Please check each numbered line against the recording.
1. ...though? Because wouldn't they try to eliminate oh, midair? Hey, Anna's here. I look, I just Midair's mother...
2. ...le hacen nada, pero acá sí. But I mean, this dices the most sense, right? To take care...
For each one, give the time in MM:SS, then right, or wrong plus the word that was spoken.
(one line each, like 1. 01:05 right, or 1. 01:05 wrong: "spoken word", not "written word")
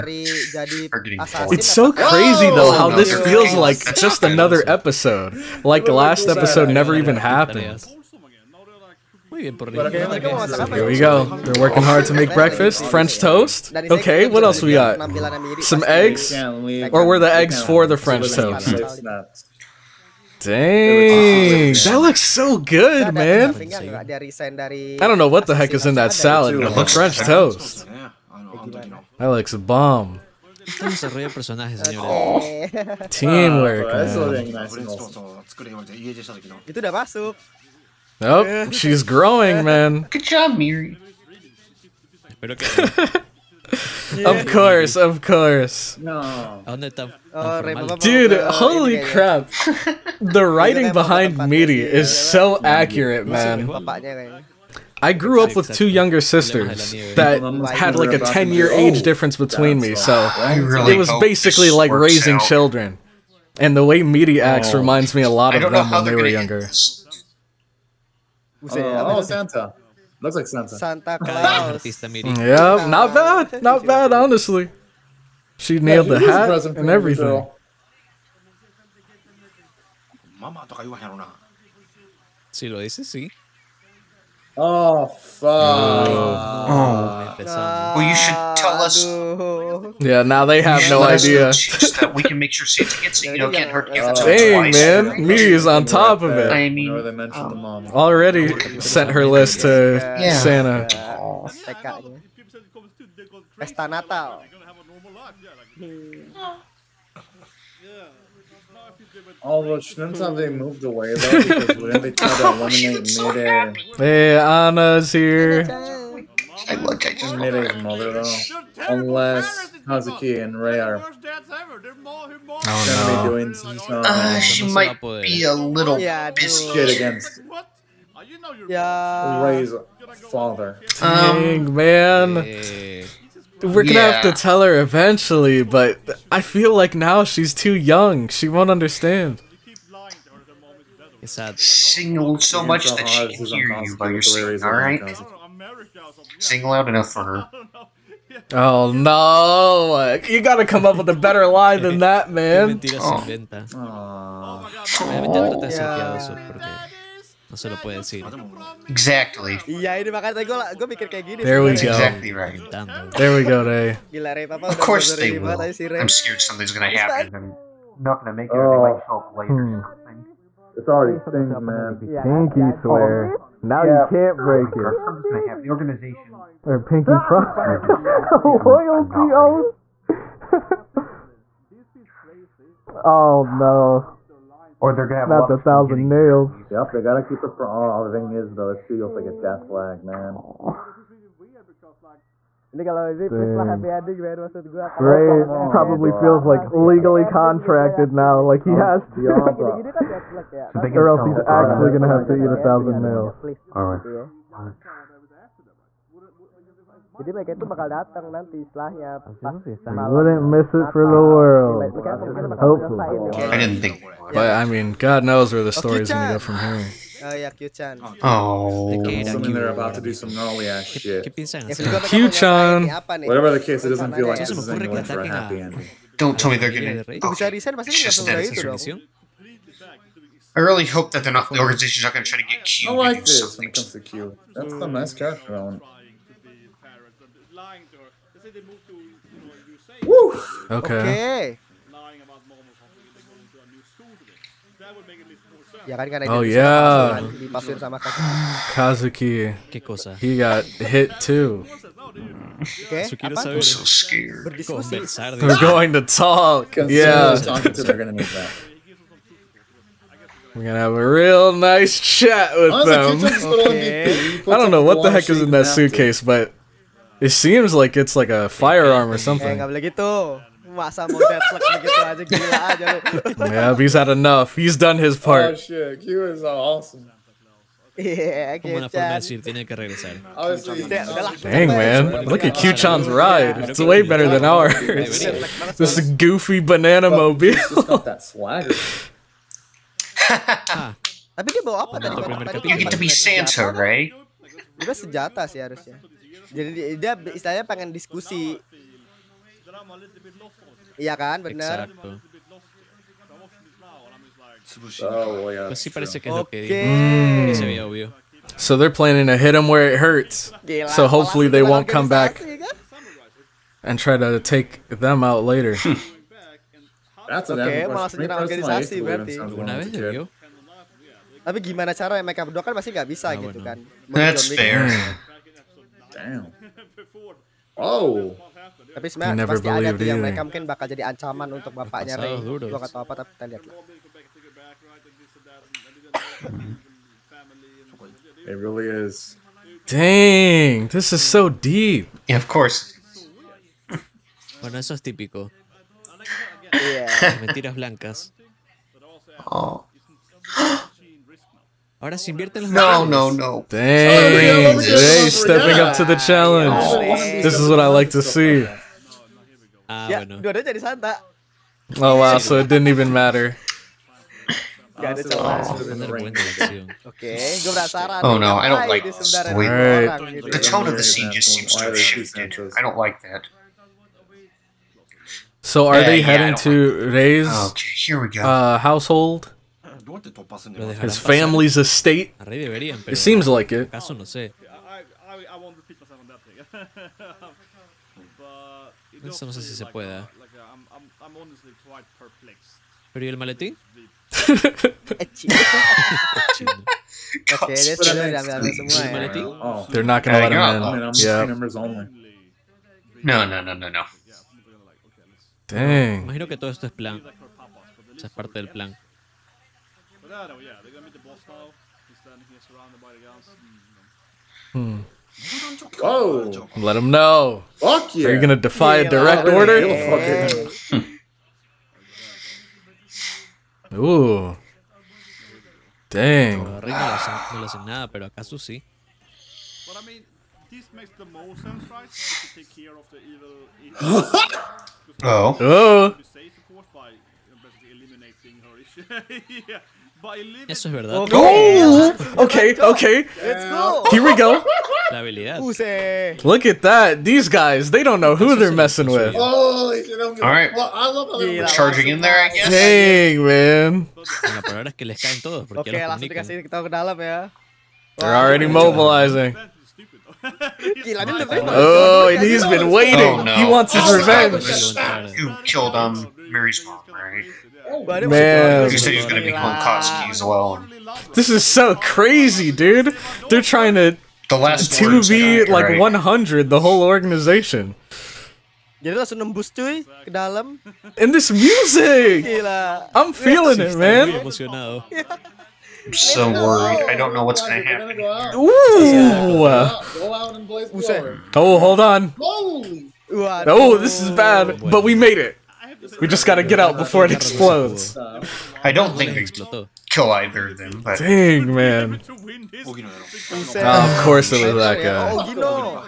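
1. 01:51 right
2. 07:06 wrong: "makes", not "dices".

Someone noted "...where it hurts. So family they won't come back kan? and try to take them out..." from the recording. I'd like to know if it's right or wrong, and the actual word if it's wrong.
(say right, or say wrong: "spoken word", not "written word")
wrong: "hopefully", not "family".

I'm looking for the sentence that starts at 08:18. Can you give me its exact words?
I don't think we kill either of them.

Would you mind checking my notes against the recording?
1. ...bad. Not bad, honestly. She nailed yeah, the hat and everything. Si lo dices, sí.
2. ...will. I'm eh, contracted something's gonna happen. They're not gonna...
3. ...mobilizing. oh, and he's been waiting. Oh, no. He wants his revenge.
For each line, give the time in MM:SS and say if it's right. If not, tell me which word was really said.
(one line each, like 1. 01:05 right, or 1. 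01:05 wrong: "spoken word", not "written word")
1. 01:13 right
2. 02:45 wrong: "scared", not "contracted"
3. 07:38 right.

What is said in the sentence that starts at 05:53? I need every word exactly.
Dang, Jay oh, stepping up to the challenge.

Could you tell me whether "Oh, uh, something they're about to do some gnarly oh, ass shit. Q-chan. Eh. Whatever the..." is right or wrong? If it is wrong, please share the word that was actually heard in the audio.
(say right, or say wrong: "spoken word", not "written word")
right.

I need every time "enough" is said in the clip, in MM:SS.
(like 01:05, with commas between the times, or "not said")
02:26, 04:34.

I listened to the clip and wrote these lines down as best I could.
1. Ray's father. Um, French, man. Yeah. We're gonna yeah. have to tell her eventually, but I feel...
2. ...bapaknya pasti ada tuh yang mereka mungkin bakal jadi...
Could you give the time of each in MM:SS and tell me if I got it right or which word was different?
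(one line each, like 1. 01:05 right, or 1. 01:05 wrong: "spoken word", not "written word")
1. 02:09 wrong: "Dang", not "French"
2. 05:29 wrong: "sebenarnya", not "bapaknya".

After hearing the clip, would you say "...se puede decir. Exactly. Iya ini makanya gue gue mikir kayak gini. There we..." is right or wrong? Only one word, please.
right.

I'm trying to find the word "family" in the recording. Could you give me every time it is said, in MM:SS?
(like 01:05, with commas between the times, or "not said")
06:21.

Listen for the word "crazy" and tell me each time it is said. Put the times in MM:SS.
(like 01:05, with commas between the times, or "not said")
00:01, 07:51.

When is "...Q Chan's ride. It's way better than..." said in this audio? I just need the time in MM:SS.
04:42.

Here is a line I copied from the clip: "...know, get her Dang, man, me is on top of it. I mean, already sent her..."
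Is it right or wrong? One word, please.
right.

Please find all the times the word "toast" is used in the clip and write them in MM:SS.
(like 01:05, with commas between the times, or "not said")
00:13, 00:18, 00:27.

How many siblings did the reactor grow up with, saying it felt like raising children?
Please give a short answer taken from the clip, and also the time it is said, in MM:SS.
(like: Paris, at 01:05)
2, at 00:55.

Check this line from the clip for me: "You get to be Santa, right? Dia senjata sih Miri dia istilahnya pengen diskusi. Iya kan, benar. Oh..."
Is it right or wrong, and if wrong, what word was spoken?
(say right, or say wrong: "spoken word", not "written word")
wrong: "Jadi", not "Miri".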